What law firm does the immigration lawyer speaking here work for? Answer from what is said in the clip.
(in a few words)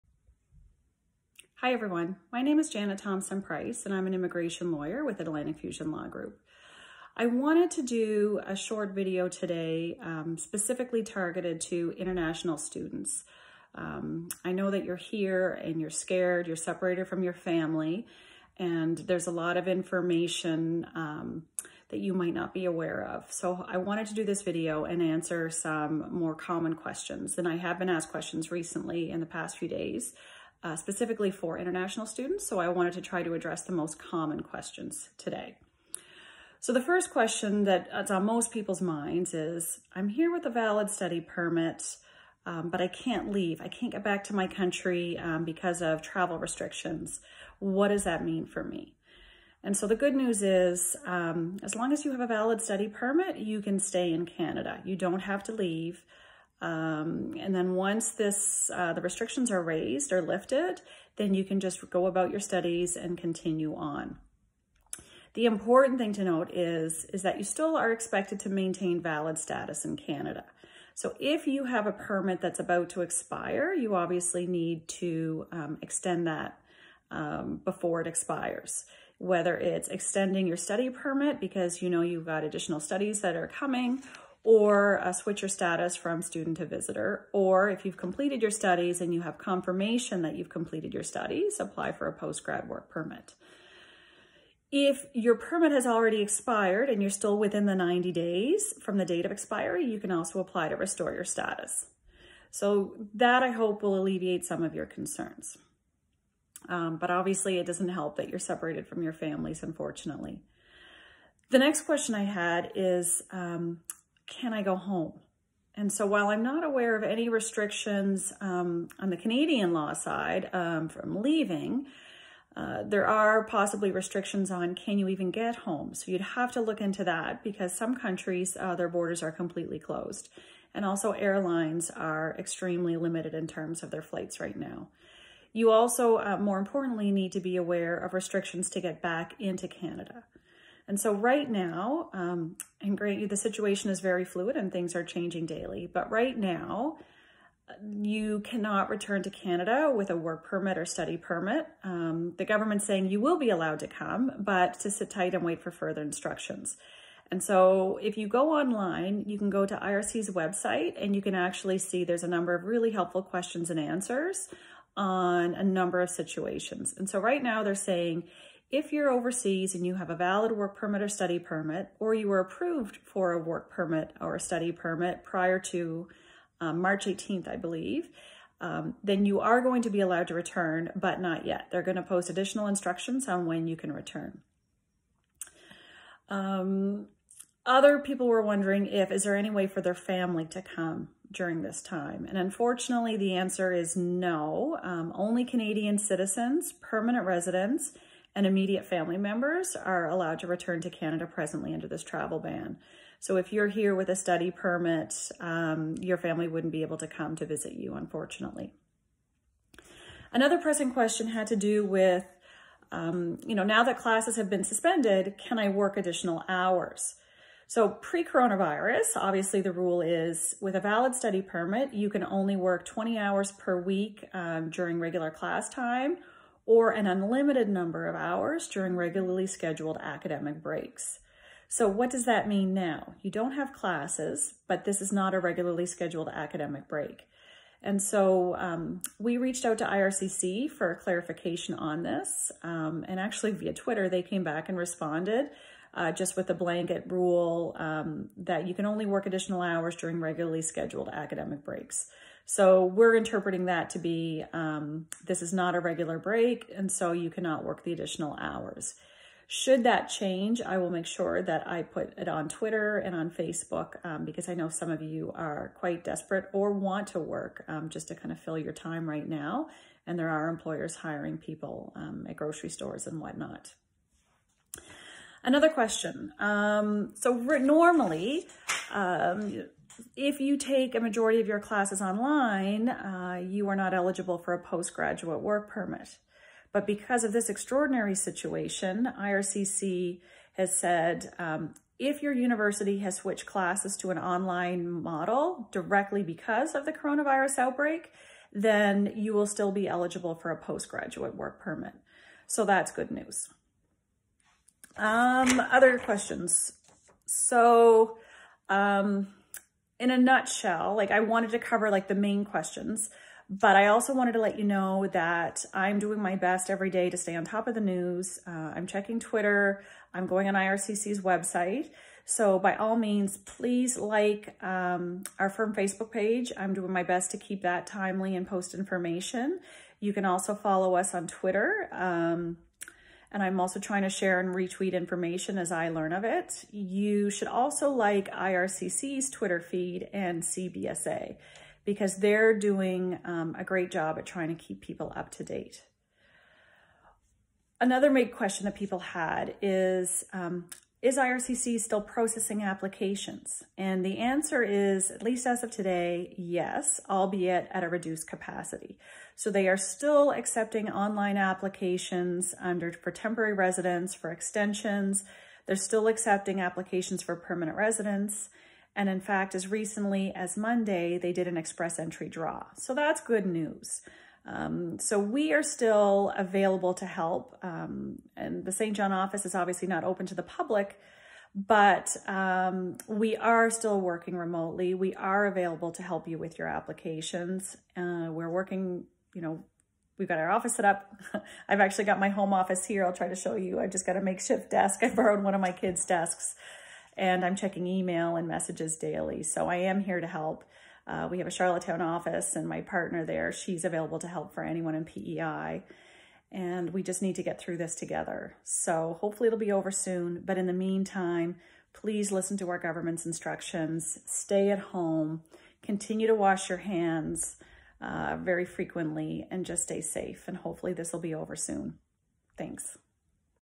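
Atlantic Fusion Law Group.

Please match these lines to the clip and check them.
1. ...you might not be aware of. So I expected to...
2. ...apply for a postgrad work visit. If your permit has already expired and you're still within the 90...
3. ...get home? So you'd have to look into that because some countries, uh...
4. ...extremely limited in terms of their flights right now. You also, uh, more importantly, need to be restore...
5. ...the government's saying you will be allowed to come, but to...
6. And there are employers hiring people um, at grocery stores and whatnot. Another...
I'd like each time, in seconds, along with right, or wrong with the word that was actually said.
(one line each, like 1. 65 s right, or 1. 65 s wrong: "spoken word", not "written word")
1. 21 s wrong: "wanted", not "expected"
2. 91 s wrong: "permit", not "visit"
3. 125 s right
4. 132 s wrong: "aware", not "restore"
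5. 152 s right
6. 270 s right.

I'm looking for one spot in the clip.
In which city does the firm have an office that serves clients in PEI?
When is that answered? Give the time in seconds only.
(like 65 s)
401 s.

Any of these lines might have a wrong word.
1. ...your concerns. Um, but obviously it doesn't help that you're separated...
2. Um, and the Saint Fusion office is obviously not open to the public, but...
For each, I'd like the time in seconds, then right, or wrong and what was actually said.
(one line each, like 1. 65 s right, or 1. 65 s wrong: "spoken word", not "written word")
1. 104 s right
2. 377 s wrong: "John", not "Fusion".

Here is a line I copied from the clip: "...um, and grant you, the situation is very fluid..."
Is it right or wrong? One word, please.
right.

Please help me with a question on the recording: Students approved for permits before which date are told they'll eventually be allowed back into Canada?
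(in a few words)
March 18th.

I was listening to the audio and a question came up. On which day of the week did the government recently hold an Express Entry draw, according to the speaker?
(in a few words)
Monday.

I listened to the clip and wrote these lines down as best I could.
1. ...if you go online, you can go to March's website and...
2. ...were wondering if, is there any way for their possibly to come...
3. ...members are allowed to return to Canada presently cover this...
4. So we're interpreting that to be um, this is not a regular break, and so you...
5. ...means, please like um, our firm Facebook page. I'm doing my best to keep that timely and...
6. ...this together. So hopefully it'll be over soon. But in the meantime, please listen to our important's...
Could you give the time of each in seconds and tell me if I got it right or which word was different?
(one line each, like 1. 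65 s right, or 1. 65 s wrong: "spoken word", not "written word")
1. 158 s wrong: "IRCC", not "March"
2. 188 s wrong: "family", not "possibly"
3. 199 s wrong: "under", not "cover"
4. 252 s right
5. 322 s right
6. 407 s wrong: "government", not "important".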